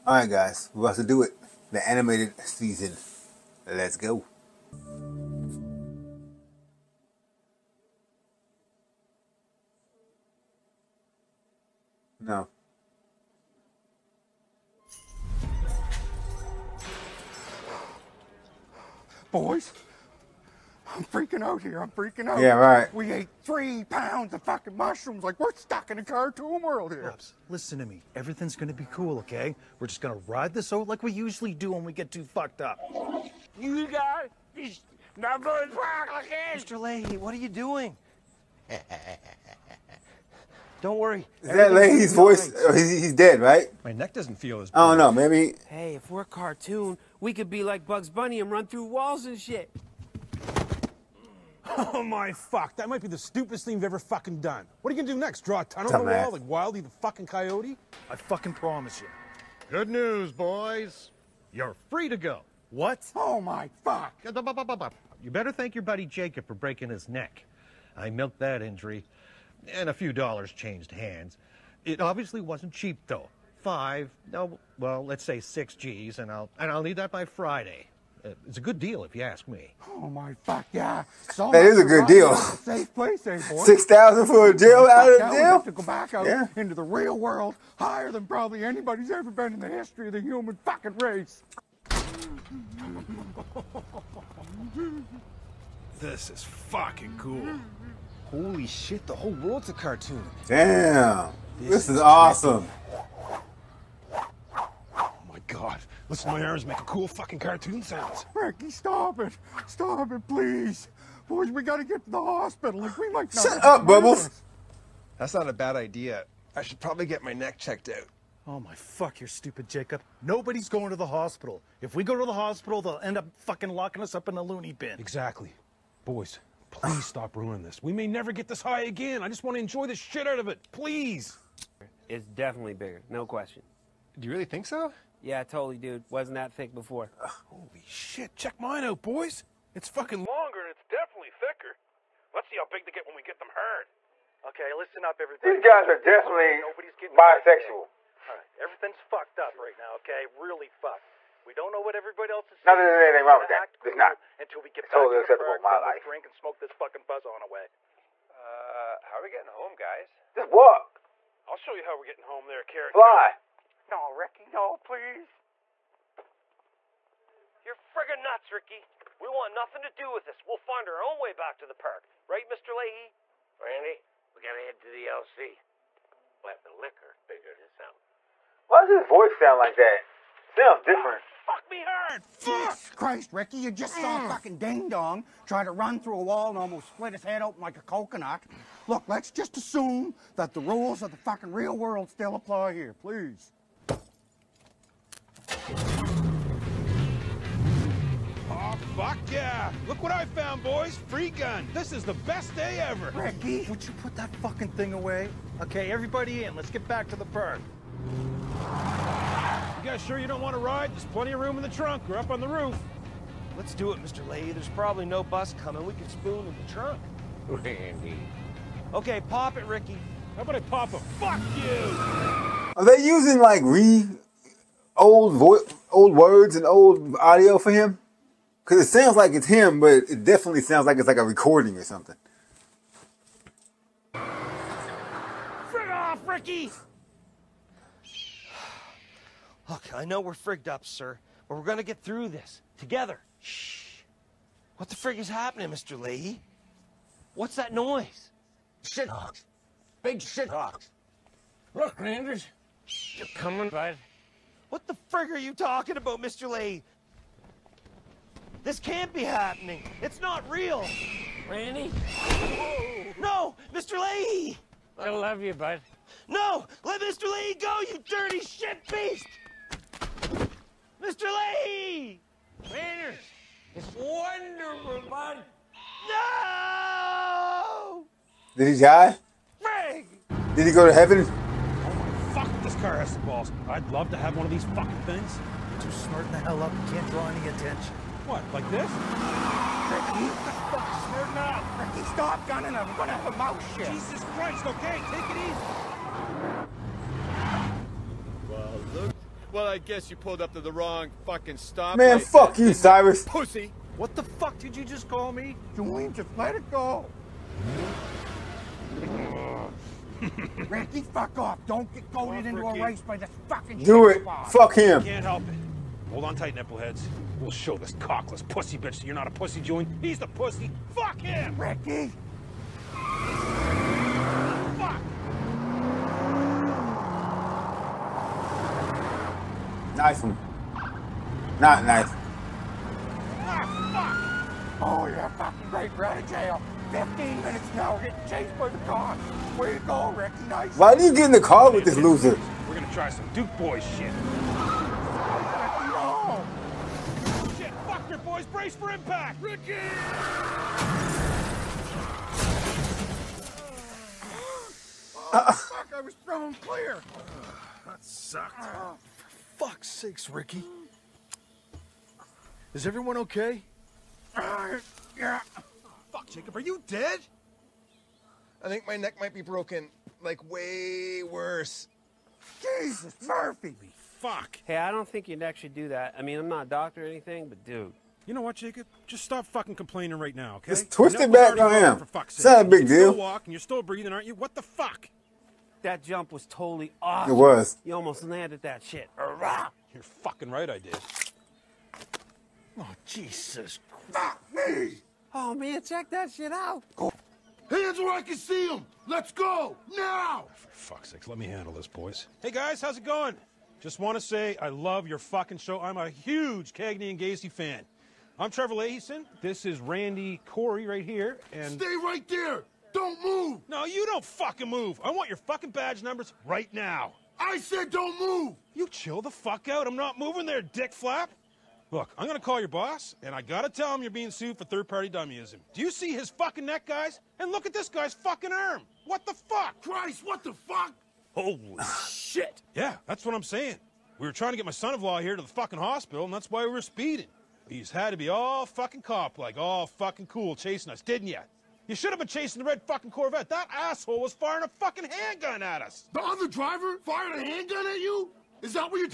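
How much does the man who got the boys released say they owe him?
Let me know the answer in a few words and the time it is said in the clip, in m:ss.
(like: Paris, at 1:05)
6 G's, at 1:15.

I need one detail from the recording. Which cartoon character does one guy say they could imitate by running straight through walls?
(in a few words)
Bugs Bunny.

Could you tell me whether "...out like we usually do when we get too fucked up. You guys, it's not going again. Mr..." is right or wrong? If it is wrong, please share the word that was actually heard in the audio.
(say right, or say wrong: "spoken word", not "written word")
right.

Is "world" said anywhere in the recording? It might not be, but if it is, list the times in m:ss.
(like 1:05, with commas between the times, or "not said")
0:26, 1:27, 1:39, 3:11.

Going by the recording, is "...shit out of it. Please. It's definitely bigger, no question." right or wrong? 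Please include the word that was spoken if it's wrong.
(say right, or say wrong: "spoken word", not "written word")
right.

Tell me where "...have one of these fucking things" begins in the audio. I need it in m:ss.
4:44.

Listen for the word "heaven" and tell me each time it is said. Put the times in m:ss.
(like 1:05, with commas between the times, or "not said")
4:40.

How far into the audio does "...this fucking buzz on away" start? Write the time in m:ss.
2:36.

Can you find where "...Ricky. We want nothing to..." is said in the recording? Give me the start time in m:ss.
2:48.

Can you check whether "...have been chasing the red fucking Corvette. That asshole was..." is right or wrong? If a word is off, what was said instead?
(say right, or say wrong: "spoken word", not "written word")
right.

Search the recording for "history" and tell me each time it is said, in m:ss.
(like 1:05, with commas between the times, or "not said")
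1:29.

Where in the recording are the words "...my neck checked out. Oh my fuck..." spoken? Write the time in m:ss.
1:57.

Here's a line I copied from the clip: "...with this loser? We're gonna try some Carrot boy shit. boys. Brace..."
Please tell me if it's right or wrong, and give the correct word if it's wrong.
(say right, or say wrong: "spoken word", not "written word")
wrong: "Duke", not "Carrot".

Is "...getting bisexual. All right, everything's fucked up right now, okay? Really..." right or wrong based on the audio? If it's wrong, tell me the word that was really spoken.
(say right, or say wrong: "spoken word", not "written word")
right.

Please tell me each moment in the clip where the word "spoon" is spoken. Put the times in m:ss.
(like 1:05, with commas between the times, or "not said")
3:36.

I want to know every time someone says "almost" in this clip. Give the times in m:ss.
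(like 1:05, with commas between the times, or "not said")
3:06, 6:27.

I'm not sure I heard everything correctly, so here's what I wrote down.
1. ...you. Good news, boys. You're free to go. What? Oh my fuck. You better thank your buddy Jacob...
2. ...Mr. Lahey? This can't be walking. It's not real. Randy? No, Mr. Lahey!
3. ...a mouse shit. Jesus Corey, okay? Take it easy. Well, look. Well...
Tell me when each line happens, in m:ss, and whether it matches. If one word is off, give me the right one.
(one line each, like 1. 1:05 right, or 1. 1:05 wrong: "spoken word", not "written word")
1. 0:58 right
2. 4:16 wrong: "happening", not "walking"
3. 4:53 wrong: "Christ", not "Corey".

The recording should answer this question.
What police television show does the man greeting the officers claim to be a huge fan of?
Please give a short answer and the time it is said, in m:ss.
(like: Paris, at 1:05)
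Cagney and Lacey, at 6:46.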